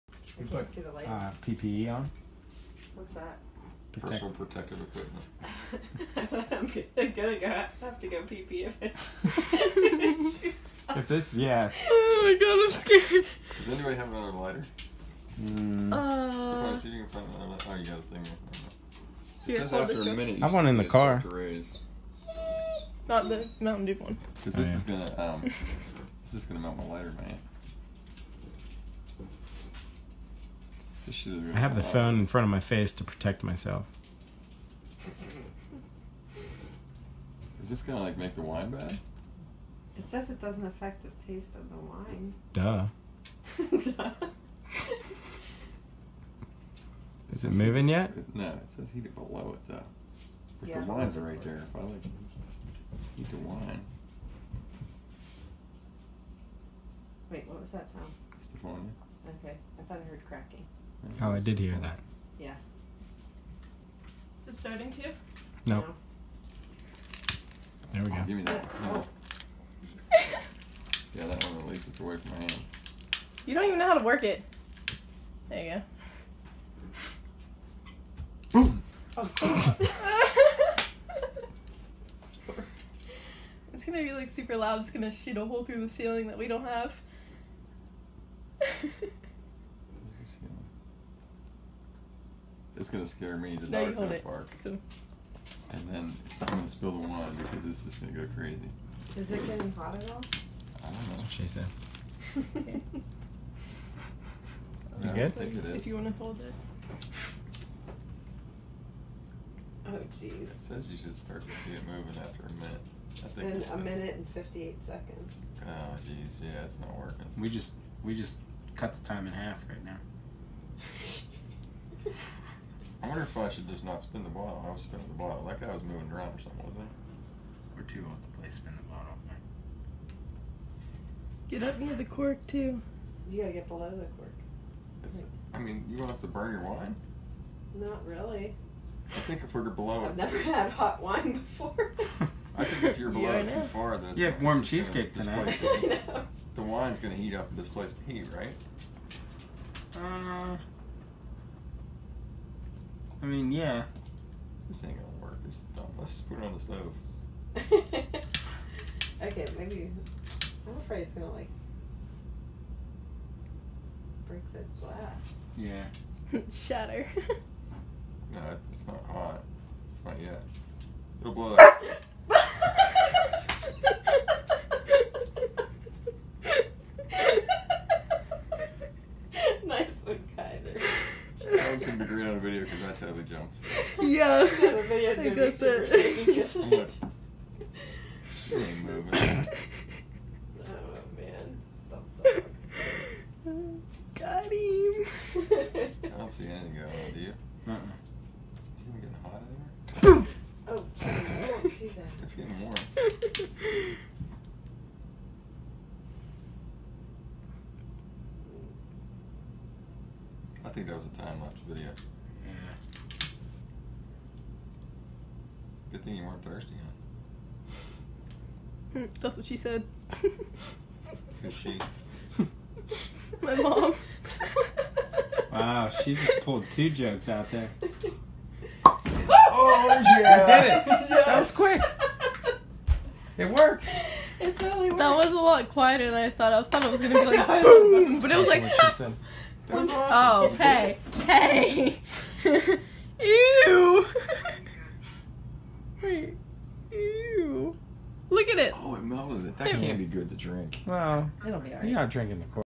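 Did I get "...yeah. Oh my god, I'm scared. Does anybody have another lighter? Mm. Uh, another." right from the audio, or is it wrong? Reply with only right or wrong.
right.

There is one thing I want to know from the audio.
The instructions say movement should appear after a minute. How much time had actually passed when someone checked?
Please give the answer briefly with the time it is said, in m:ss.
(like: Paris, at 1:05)
1 minute 58 seconds, at 1:53.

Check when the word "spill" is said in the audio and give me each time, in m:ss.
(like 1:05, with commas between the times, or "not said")
1:36.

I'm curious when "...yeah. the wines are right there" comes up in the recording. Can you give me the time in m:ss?
0:50.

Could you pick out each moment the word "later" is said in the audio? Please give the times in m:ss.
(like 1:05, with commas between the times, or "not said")
not said.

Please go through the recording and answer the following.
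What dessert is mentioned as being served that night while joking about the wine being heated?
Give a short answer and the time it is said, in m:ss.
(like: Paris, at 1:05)
Cheesecake, at 2:24.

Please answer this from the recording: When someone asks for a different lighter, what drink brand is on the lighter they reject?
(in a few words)
Mountain Dew.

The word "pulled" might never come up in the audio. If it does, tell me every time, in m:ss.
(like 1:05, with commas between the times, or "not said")
3:46.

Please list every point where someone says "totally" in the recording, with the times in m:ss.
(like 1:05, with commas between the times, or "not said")
3:02, 3:54.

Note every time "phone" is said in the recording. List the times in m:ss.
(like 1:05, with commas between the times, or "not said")
0:31, 0:58.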